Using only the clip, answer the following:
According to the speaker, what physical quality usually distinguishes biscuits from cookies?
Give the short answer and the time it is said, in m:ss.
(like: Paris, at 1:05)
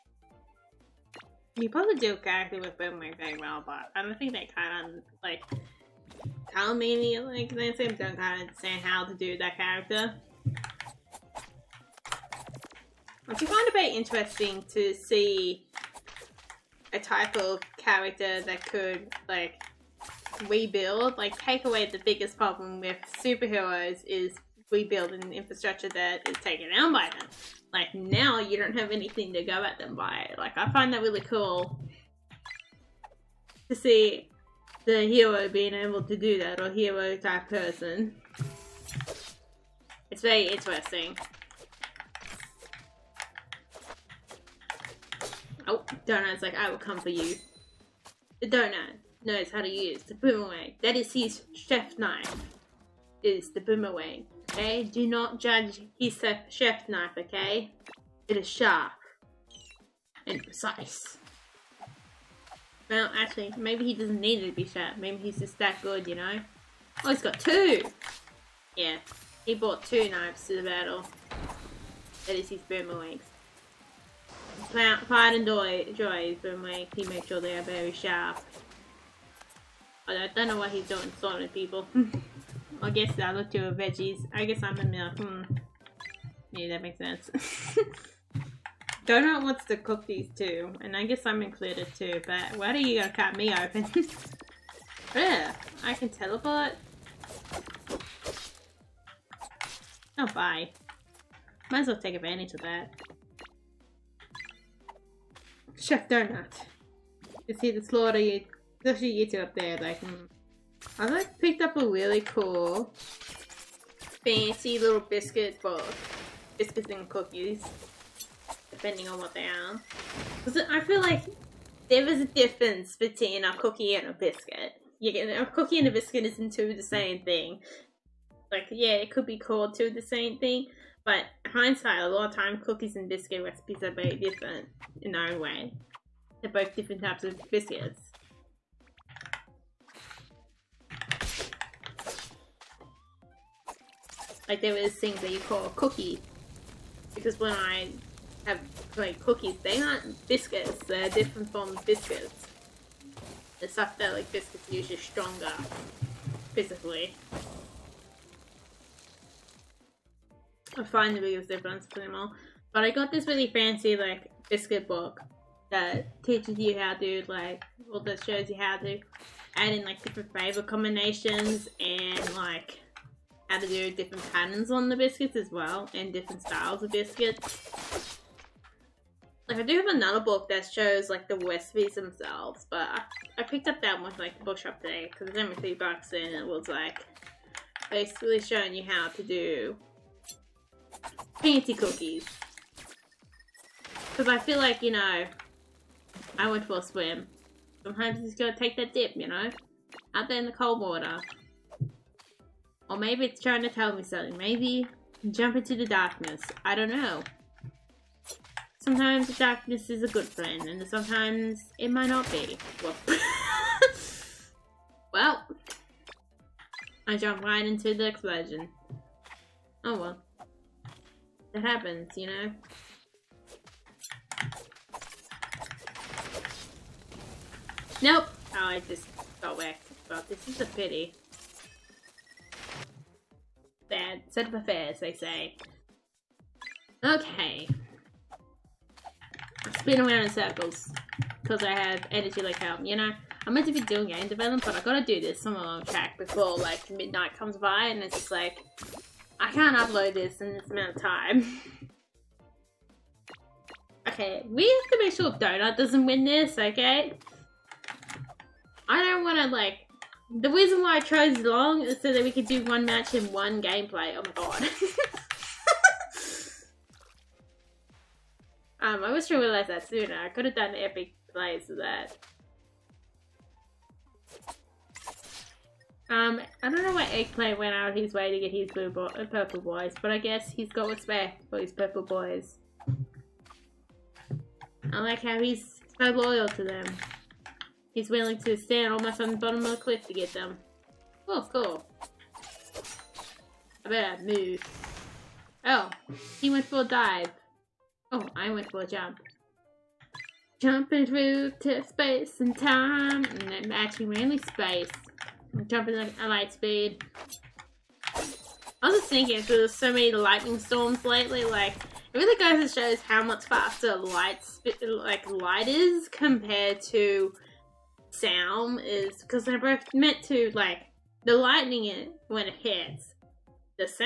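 stronger, at 2:34.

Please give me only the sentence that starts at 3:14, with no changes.
Because I feel like, you know, I went for a swim.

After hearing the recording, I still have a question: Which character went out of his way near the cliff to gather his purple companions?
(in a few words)
Eggplant.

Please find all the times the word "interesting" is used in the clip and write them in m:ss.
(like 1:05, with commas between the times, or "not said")
0:13, 0:40.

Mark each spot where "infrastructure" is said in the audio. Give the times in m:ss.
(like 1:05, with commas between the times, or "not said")
0:25.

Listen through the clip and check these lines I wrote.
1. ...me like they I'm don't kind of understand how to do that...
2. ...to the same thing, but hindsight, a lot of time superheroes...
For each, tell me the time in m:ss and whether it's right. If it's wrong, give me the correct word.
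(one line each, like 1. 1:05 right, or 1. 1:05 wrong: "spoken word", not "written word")
1. 0:06 right
2. 2:09 wrong: "cookies", not "superheroes".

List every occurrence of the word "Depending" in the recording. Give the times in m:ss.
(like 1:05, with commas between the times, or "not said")
1:58.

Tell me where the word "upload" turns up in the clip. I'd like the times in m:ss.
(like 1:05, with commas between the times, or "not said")
4:09.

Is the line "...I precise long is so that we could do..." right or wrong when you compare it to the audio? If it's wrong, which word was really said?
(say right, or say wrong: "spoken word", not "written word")
wrong: "chose", not "precise".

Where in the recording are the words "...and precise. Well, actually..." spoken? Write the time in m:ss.
1:00.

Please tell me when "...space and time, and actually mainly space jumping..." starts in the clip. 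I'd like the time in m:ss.
5:01.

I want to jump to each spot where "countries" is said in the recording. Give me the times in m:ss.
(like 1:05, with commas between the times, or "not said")
not said.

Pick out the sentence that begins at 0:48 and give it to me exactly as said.
The donut knows how to use the boomerang.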